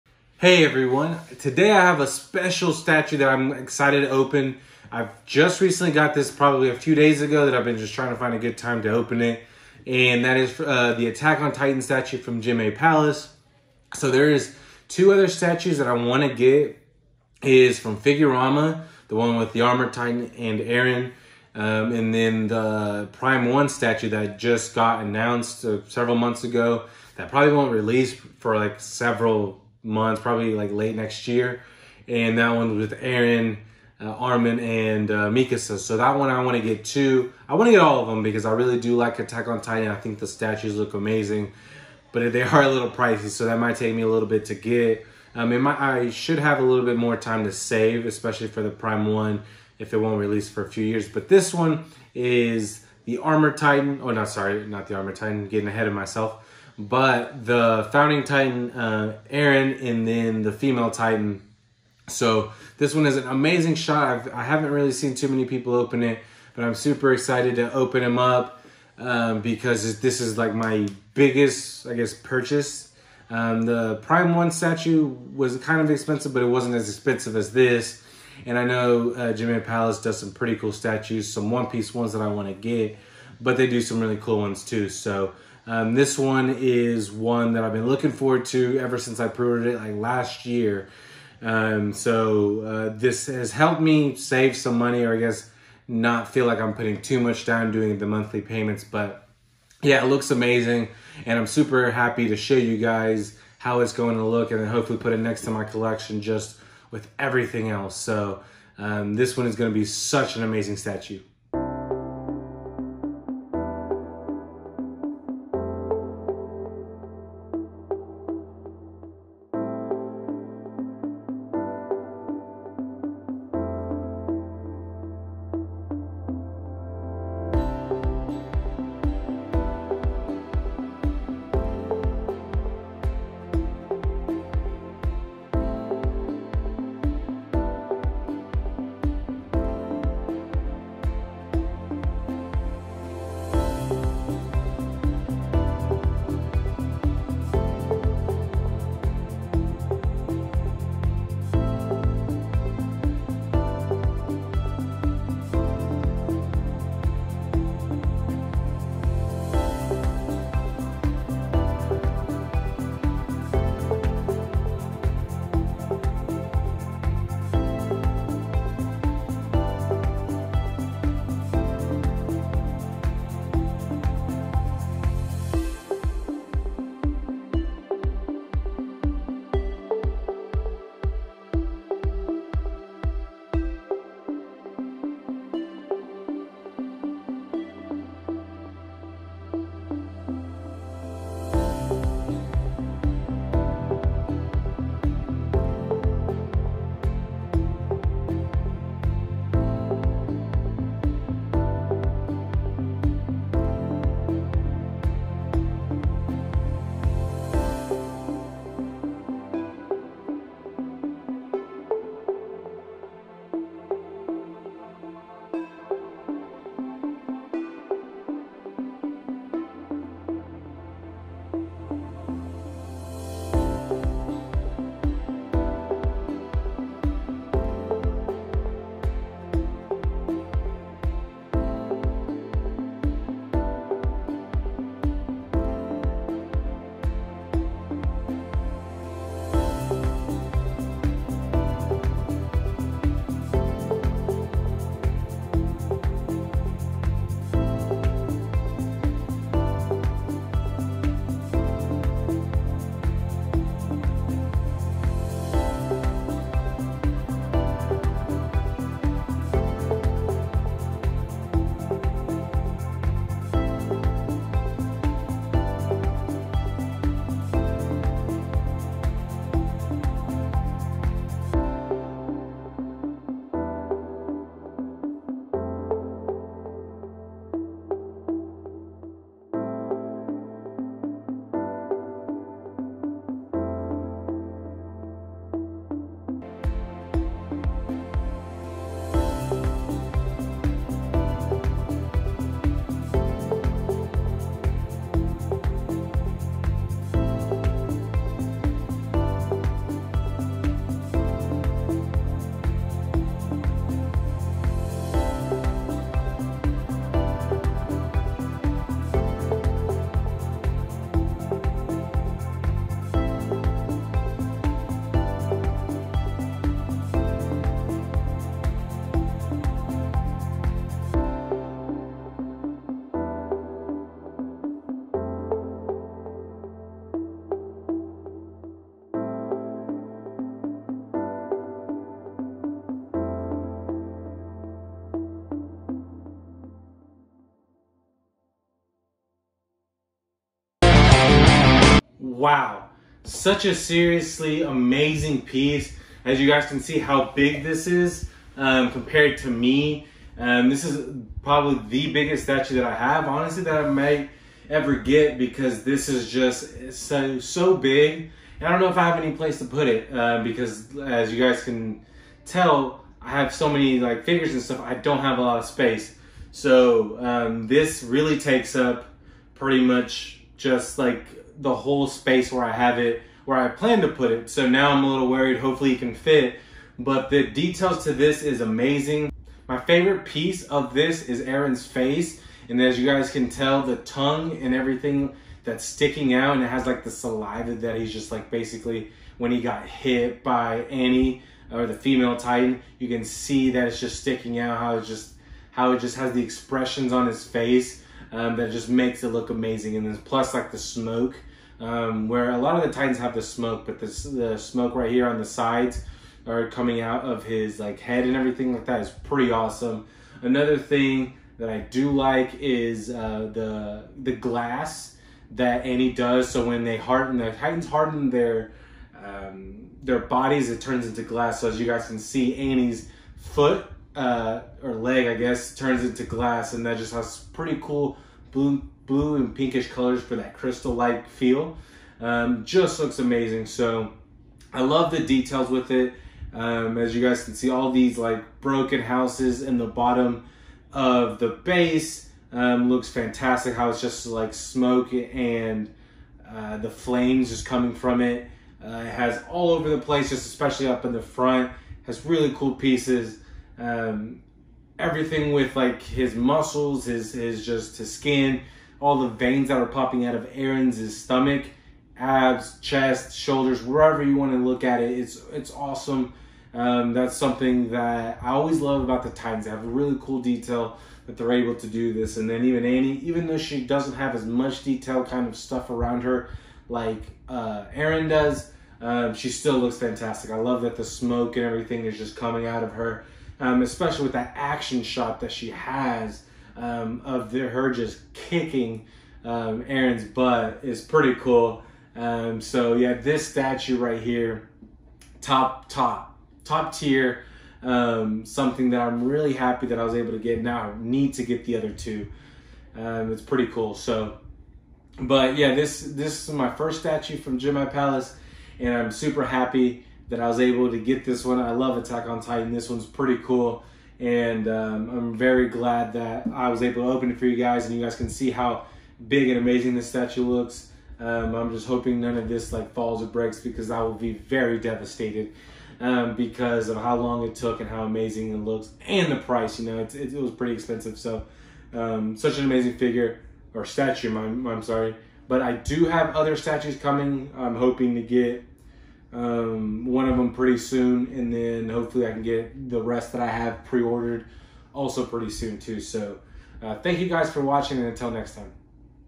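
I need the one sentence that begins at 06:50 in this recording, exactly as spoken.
Another thing that I do like is uh, the the glass that Annie does.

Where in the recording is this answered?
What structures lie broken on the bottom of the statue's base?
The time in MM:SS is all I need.
07:18.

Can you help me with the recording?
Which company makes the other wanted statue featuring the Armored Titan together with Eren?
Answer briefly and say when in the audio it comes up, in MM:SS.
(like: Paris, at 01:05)
Figurama, at 00:17.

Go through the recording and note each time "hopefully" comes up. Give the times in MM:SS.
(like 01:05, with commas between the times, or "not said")
01:44, 06:15, 09:01.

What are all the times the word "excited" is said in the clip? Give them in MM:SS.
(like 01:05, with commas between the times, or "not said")
00:03, 01:07.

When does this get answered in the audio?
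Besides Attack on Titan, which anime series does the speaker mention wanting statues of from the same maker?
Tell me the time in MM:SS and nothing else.
01:21.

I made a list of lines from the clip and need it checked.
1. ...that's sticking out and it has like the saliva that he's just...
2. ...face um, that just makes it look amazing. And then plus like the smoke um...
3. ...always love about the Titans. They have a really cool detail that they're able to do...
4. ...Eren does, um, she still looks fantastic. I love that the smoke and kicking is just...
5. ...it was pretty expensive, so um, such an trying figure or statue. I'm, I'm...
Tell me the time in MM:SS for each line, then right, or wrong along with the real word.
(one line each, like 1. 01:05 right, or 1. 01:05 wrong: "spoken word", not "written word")
1. 06:25 right
2. 06:37 right
3. 07:48 right
4. 07:57 wrong: "everything", not "kicking"
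5. 08:50 wrong: "amazing", not "trying".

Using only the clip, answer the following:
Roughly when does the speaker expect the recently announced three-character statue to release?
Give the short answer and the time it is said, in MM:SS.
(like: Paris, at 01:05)
late next year, at 00:30.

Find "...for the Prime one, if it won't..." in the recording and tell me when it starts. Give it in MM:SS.
00:48.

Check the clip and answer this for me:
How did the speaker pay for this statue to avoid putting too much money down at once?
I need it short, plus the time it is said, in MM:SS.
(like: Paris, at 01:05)
Monthly payments, at 01:38.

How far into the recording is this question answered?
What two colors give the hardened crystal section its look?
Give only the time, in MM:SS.
07:09.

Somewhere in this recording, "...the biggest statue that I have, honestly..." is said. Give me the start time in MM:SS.
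05:51.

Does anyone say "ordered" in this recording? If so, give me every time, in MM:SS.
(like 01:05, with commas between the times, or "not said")
01:29, 09:03.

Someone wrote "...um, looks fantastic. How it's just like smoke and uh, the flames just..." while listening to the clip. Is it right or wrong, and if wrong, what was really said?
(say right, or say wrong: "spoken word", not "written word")
right.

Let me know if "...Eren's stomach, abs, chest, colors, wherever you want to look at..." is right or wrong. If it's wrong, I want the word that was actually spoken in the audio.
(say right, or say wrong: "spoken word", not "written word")
wrong: "shoulders", not "colors".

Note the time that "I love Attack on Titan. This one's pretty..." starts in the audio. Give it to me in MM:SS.
08:31.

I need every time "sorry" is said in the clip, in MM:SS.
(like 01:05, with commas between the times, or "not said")
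00:54, 08:54.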